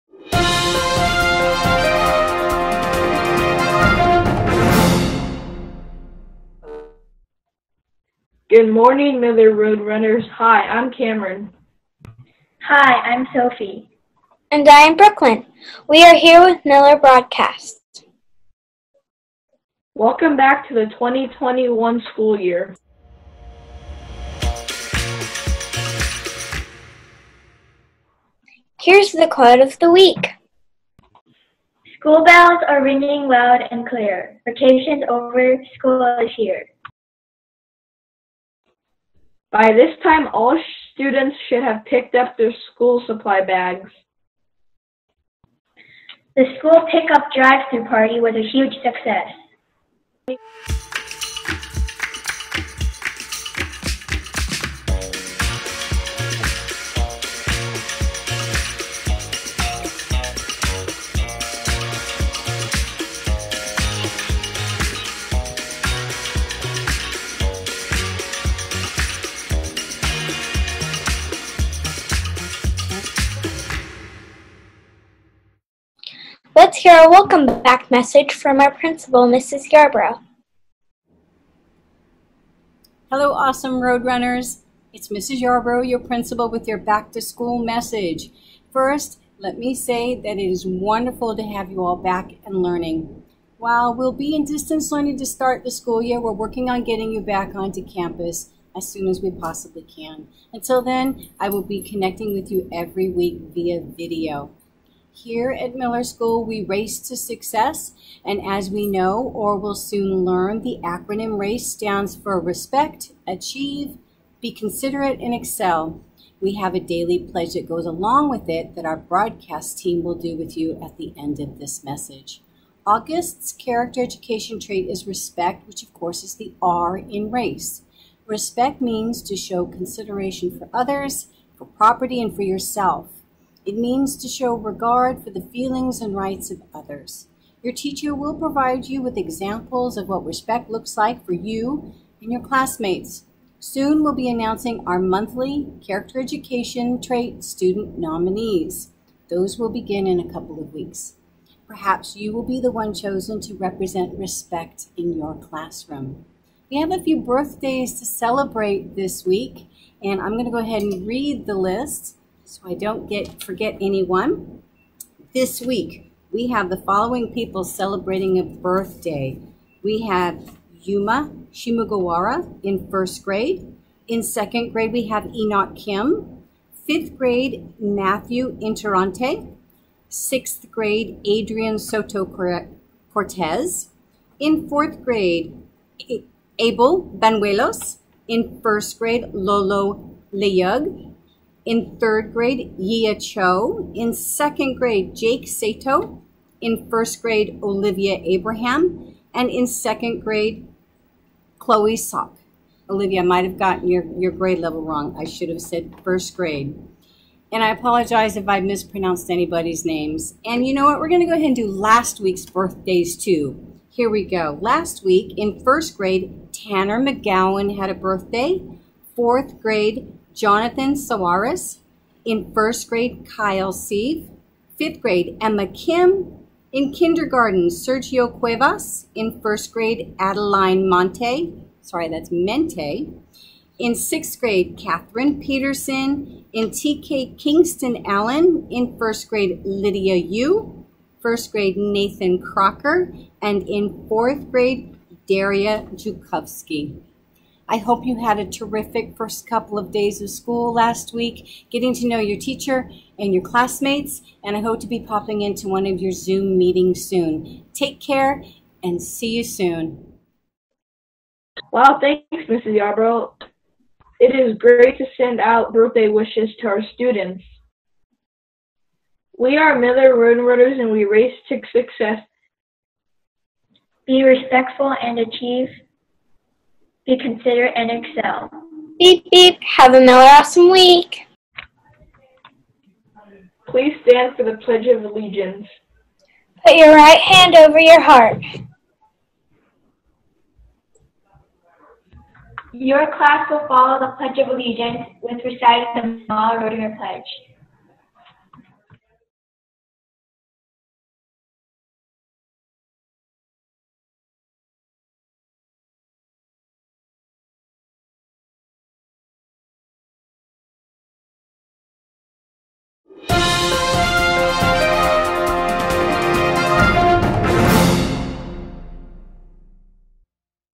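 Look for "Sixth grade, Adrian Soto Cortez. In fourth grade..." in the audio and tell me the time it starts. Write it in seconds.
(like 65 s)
180 s.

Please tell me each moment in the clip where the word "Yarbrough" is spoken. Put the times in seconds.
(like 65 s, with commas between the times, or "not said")
79 s, 85 s, 262 s.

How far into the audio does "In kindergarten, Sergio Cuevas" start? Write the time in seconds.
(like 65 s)
226 s.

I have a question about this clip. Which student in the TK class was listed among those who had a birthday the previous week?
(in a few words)
Kingston Allen.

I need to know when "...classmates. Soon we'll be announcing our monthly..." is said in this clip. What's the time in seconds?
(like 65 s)
142 s.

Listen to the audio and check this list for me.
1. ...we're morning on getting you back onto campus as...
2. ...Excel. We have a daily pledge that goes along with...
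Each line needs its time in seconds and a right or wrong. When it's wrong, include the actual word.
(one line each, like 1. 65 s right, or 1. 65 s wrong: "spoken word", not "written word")
1. 96 s wrong: "working", not "morning"
2. 115 s right.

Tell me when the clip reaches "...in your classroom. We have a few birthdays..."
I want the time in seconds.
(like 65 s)
154 s.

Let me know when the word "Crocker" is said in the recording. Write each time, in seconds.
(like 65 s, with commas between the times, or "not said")
242 s.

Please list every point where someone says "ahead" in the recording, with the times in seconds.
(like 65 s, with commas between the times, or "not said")
160 s, 211 s.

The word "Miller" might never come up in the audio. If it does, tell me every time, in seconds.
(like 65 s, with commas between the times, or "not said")
9 s, 16 s, 105 s, 269 s.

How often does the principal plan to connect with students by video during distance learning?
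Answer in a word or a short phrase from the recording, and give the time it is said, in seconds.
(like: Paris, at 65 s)
every week, at 102 s.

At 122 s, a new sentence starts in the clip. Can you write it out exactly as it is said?
August's character education trait is respect, which of course is the R in race.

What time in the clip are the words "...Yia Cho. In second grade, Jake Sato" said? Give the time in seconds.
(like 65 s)
192 s.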